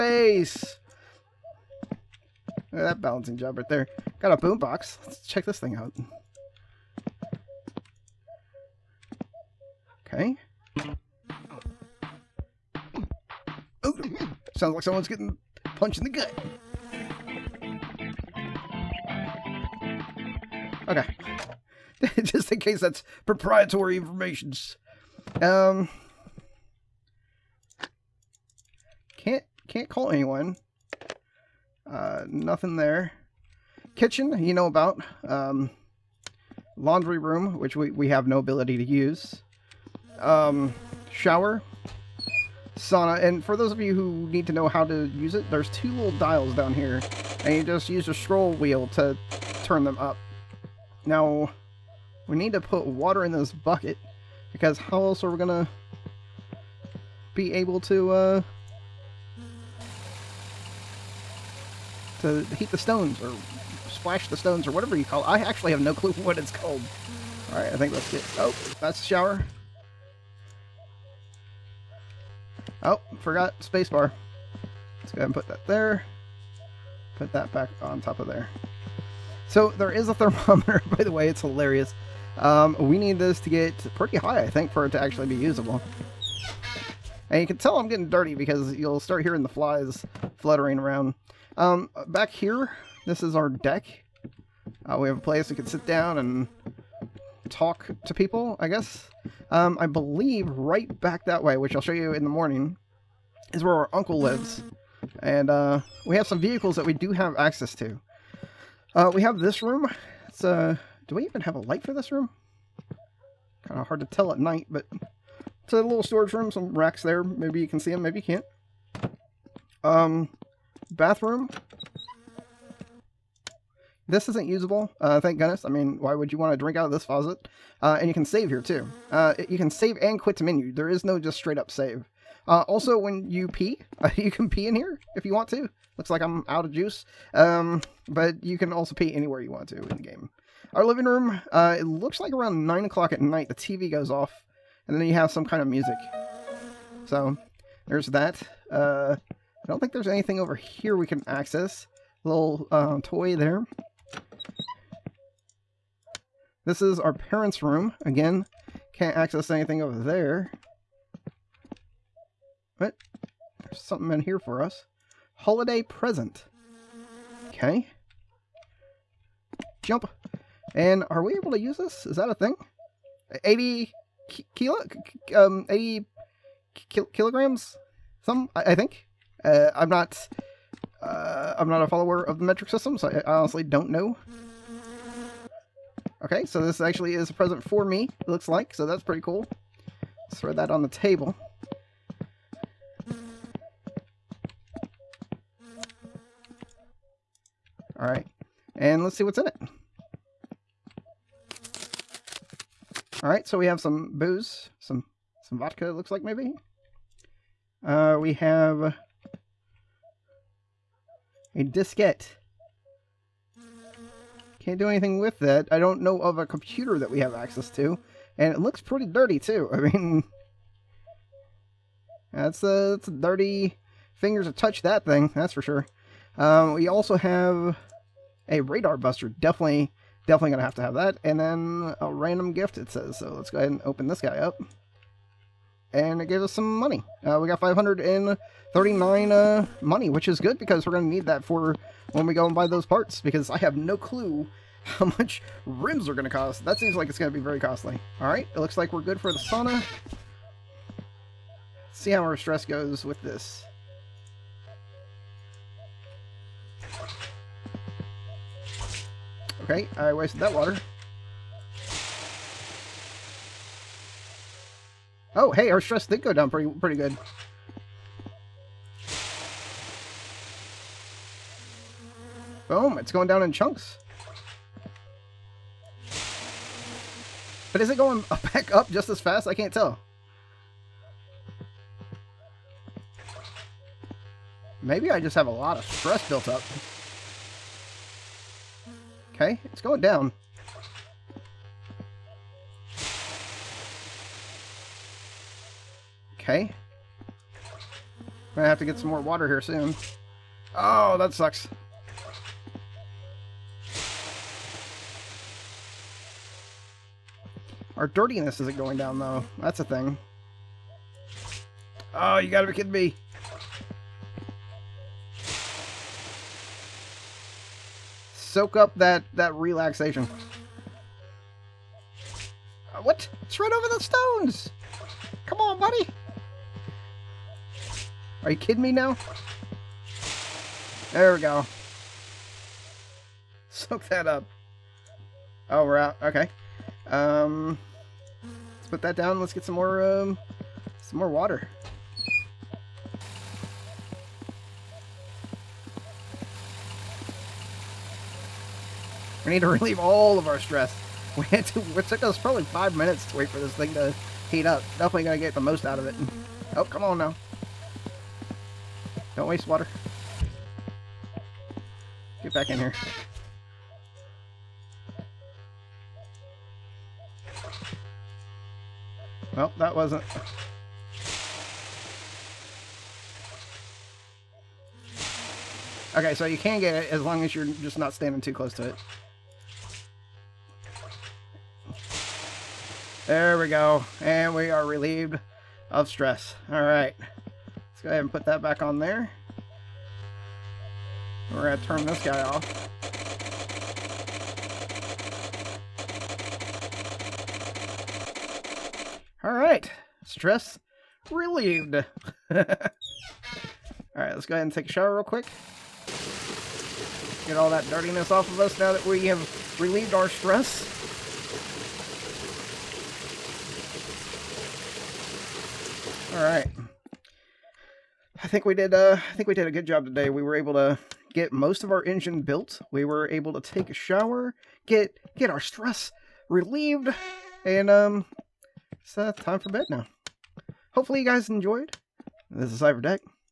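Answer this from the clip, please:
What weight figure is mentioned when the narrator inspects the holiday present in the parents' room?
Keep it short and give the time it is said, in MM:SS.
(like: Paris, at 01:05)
80 kilograms, at 02:53.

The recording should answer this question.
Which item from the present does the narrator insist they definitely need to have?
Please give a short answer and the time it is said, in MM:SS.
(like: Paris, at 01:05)
radar buster, at 03:48.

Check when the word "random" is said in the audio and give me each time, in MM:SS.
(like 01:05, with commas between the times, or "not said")
03:52.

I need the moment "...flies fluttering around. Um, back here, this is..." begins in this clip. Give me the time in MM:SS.
01:29.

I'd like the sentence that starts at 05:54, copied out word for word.
Definitely gonna get the most out of it.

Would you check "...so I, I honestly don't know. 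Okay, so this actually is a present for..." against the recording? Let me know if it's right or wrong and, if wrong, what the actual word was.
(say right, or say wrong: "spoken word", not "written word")
right.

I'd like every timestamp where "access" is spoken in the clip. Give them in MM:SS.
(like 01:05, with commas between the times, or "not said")
01:47, 02:31, 02:39, 03:37.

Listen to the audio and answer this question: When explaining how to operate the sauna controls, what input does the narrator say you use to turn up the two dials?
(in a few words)
scroll wheel.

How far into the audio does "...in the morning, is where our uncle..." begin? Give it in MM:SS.
01:42.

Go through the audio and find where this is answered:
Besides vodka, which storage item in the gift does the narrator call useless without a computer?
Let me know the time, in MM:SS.
03:31.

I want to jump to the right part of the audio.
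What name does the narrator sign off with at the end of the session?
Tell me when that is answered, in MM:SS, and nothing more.
07:12.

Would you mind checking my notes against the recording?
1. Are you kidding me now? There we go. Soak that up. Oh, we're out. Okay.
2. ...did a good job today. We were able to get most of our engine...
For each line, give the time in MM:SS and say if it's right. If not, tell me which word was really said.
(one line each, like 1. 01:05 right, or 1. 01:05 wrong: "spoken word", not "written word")
1. 05:28 right
2. 06:59 right.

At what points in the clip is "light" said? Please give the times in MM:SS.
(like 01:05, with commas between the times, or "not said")
01:51.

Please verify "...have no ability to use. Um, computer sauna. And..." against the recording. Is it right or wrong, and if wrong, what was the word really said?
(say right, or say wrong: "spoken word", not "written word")
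wrong: "shower", not "computer".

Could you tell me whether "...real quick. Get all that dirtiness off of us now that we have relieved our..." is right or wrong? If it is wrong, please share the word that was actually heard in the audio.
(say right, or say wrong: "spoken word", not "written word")
right.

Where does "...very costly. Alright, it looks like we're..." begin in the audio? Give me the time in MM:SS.
04:07.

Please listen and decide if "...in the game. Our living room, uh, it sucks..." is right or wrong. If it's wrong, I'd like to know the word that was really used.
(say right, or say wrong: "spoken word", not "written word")
wrong: "looks", not "sucks".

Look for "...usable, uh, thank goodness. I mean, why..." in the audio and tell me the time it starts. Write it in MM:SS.
02:04.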